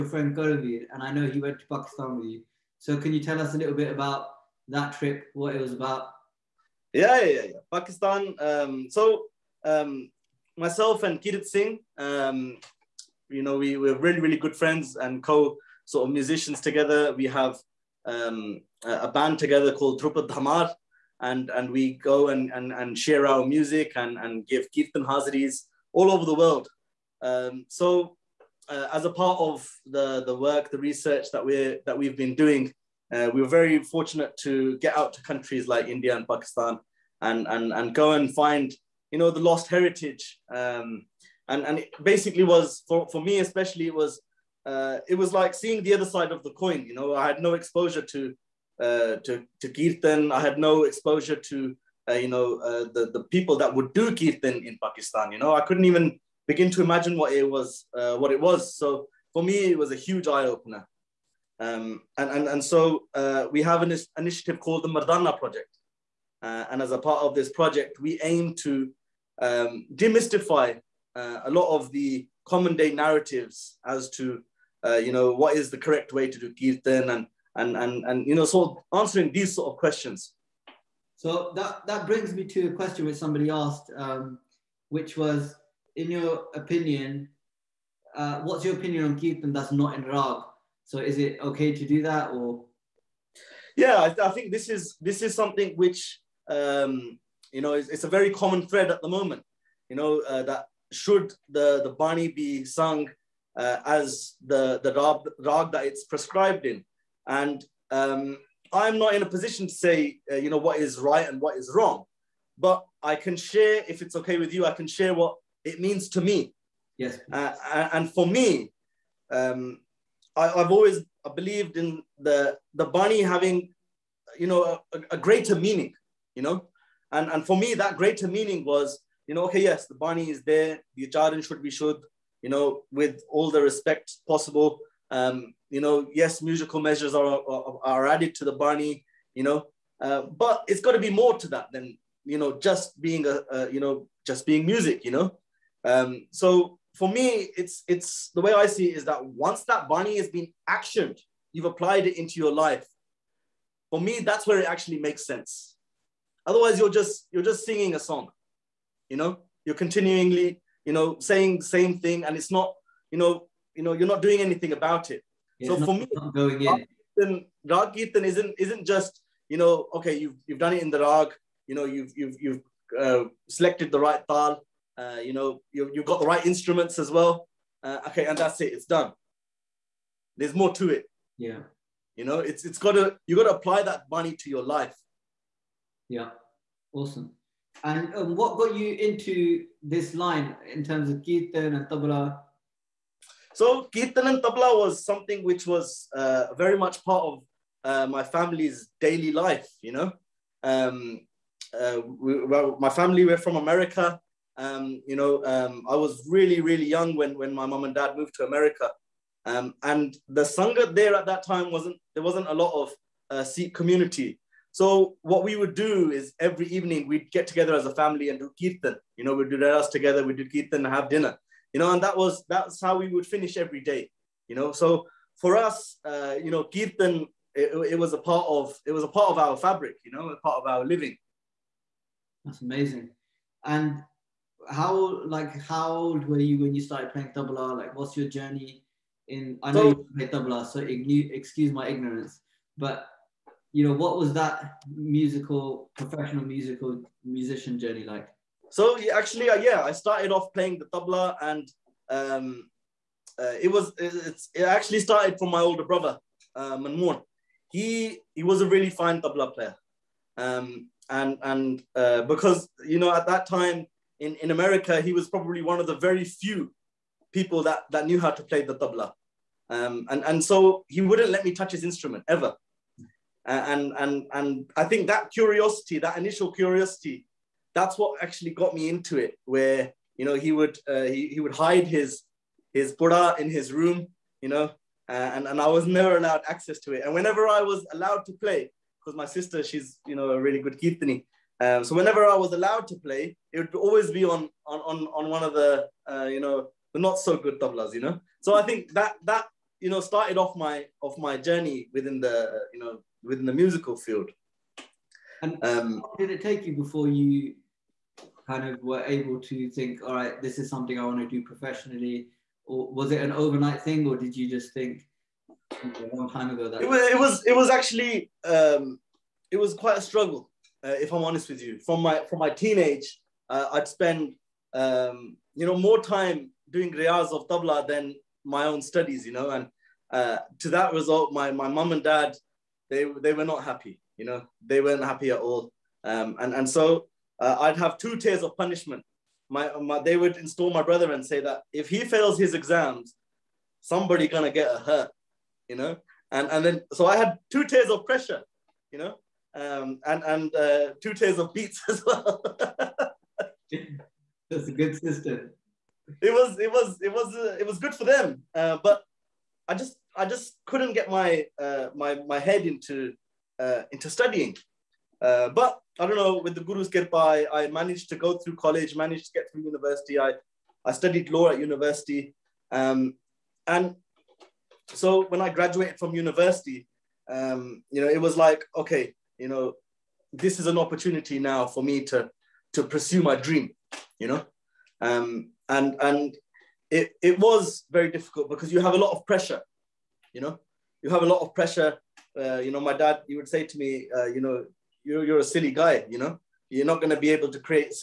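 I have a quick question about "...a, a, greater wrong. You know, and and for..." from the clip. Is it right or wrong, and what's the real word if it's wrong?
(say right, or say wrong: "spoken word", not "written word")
wrong: "meaning", not "wrong".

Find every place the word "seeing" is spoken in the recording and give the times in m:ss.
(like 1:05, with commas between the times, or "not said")
0:45.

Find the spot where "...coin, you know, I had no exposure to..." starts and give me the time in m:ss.
0:46.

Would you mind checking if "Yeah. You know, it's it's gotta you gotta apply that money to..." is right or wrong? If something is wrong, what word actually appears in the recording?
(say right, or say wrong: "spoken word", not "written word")
right.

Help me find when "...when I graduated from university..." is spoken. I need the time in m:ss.
6:15.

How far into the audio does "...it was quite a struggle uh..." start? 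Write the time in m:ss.
5:19.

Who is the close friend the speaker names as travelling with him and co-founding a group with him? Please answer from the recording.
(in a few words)
Kirit Singh.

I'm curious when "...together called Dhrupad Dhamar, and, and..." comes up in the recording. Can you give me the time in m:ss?
0:19.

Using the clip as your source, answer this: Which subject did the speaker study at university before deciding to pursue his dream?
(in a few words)
Law.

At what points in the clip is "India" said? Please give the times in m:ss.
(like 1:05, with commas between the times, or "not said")
0:35.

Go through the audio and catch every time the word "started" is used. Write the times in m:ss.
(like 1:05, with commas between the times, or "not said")
3:56, 4:09, 4:15, 5:00.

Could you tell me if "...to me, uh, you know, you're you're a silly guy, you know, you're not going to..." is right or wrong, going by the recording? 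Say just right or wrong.
right.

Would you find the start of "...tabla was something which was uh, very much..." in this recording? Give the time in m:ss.
3:14.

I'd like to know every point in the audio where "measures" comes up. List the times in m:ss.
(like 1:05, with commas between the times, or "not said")
2:16.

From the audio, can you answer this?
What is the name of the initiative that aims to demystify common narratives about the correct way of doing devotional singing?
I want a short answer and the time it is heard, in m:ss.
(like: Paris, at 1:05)
Mardana Project, at 1:04.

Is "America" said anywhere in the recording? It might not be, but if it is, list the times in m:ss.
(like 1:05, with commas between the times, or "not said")
3:23, 3:28, 4:24.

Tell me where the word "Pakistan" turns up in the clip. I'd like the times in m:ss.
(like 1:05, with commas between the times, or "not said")
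0:01, 0:07, 0:36, 0:54.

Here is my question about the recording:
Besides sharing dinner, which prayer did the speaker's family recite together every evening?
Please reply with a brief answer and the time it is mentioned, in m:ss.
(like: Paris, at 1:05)
Rehras, at 3:39.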